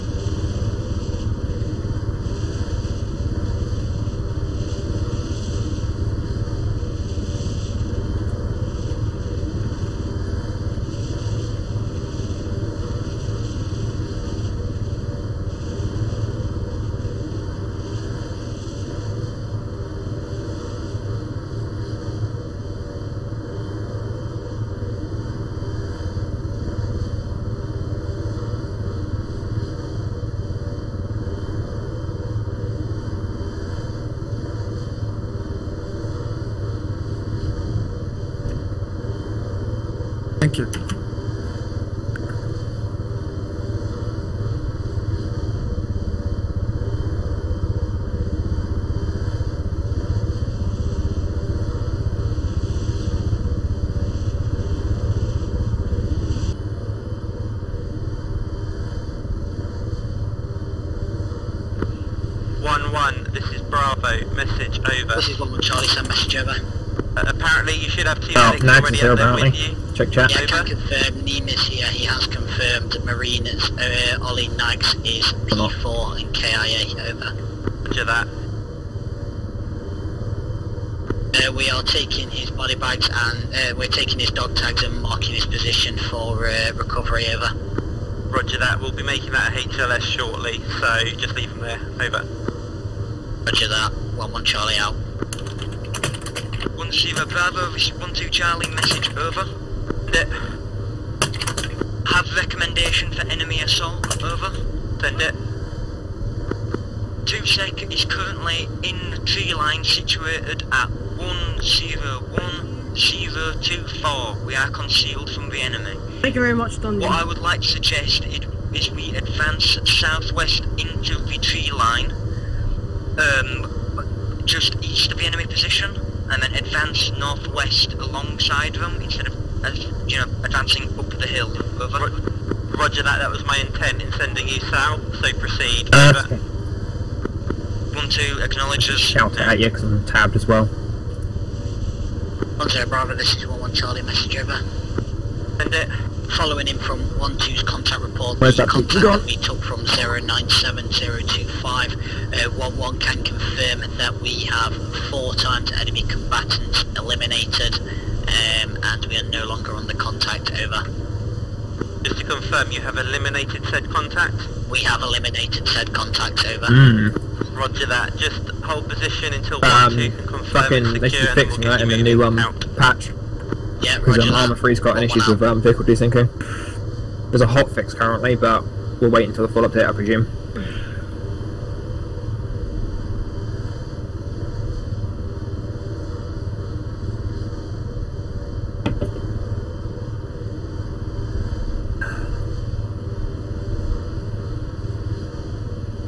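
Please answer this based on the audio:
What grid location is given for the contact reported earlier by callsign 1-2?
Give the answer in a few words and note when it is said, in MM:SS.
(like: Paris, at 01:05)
097025, at 02:29.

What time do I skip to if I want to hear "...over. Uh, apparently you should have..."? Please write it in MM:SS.
01:06.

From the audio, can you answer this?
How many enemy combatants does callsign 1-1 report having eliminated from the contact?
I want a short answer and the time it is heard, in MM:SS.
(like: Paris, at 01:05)
4, at 02:35.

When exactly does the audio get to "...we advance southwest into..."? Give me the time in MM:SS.
01:58.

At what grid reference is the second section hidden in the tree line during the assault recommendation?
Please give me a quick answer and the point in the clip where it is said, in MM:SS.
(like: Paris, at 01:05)
101024, at 01:51.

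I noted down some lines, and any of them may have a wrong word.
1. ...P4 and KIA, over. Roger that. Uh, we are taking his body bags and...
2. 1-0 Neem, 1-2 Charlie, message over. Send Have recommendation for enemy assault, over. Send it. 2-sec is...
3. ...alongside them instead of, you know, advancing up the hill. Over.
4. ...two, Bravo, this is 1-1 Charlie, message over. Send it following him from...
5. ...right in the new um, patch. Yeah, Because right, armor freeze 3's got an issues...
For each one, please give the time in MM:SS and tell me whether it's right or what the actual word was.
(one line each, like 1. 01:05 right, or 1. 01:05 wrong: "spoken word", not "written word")
1. 01:15 right
2. 01:36 wrong: "Bravo", not "Neem"
3. 02:07 right
4. 02:22 right
5. 02:51 right.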